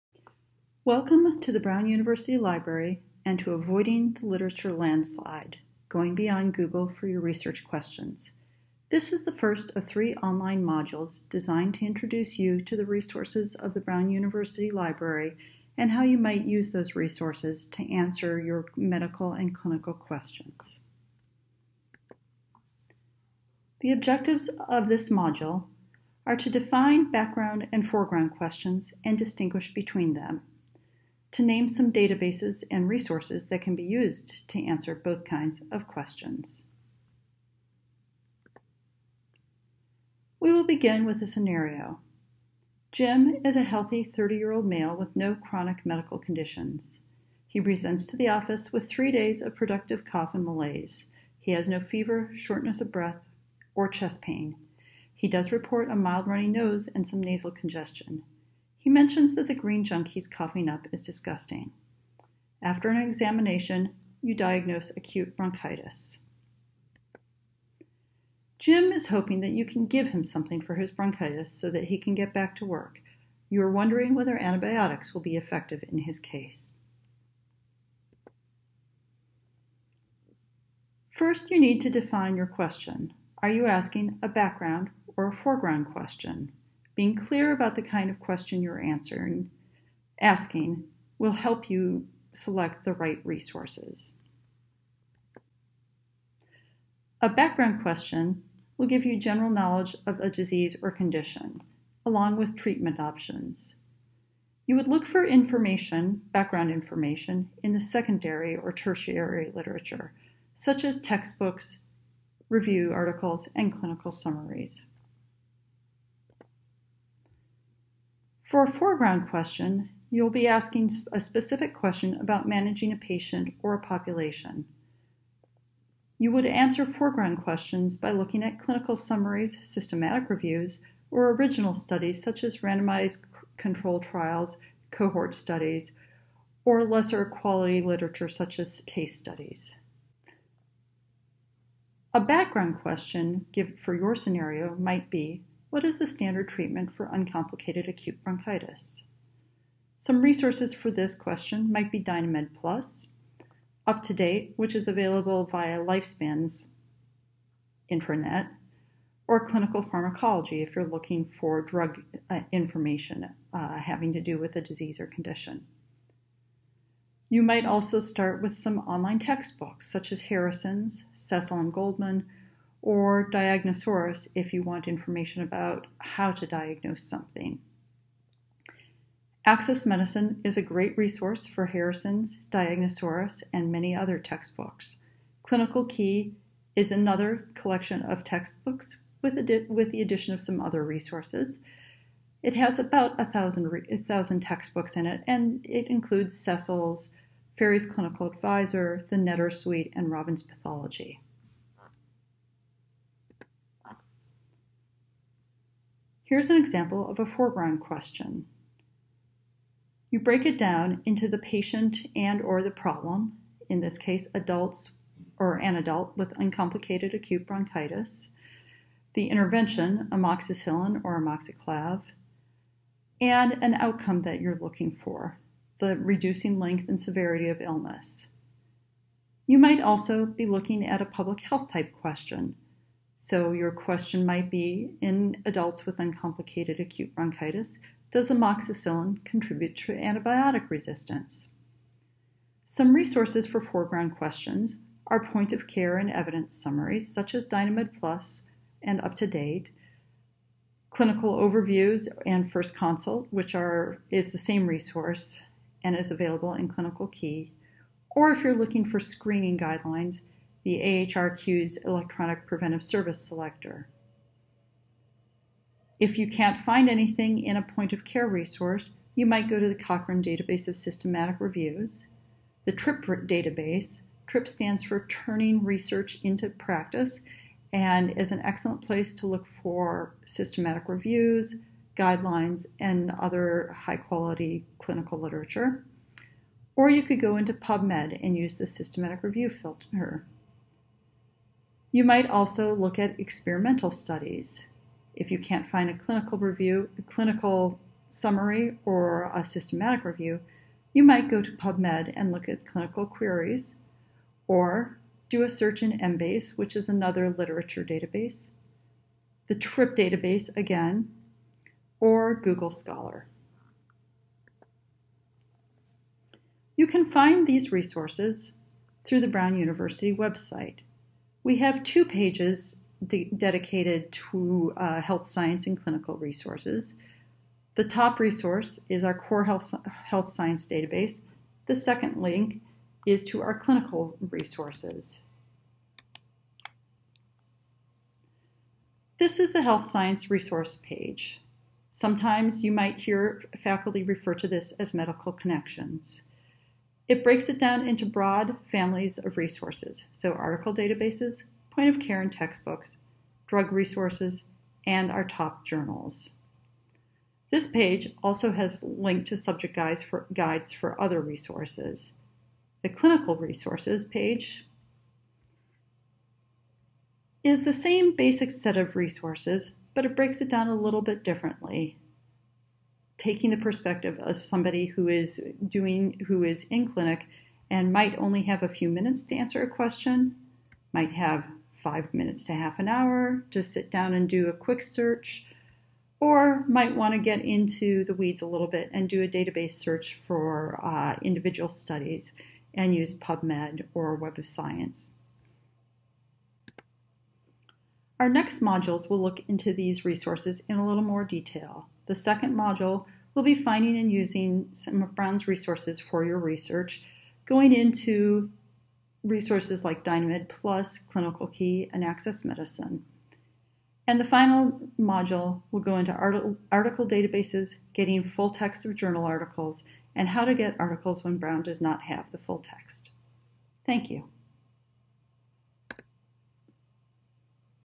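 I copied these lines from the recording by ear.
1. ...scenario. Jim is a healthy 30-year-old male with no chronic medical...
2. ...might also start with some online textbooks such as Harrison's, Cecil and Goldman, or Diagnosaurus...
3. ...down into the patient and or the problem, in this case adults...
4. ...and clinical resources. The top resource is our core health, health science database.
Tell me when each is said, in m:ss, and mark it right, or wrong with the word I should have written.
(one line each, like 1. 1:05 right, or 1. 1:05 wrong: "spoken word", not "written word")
1. 0:41 right
2. 2:47 right
3. 3:30 right
4. 5:25 right.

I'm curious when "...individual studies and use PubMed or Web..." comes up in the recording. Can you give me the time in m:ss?
6:31.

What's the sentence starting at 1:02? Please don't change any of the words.
After an examination, you diagnose acute bronchitis.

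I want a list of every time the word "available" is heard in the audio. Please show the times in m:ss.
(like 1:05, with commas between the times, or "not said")
2:34, 4:16.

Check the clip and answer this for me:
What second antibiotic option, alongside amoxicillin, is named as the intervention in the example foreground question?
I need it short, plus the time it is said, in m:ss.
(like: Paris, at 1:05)
Amoxiclav, at 3:41.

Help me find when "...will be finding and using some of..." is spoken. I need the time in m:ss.
6:43.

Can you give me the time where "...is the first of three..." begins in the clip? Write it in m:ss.
0:09.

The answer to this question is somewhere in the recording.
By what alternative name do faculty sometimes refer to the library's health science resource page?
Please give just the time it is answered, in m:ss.
5:44.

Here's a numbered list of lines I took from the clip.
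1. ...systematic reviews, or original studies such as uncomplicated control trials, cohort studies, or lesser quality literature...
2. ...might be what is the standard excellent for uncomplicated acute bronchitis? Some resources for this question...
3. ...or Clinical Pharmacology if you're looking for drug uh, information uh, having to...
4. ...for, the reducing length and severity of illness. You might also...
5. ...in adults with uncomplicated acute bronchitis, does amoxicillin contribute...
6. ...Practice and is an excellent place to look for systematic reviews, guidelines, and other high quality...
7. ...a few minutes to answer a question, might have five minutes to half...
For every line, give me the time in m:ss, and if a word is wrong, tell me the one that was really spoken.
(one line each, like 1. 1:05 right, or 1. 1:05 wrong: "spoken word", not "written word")
1. 2:09 wrong: "randomized", not "uncomplicated"
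2. 2:24 wrong: "treatment", not "excellent"
3. 2:39 right
4. 3:44 right
5. 3:54 right
6. 4:36 right
7. 6:18 right.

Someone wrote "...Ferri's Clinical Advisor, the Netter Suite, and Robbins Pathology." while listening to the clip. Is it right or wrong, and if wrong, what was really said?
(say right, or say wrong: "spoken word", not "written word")
right.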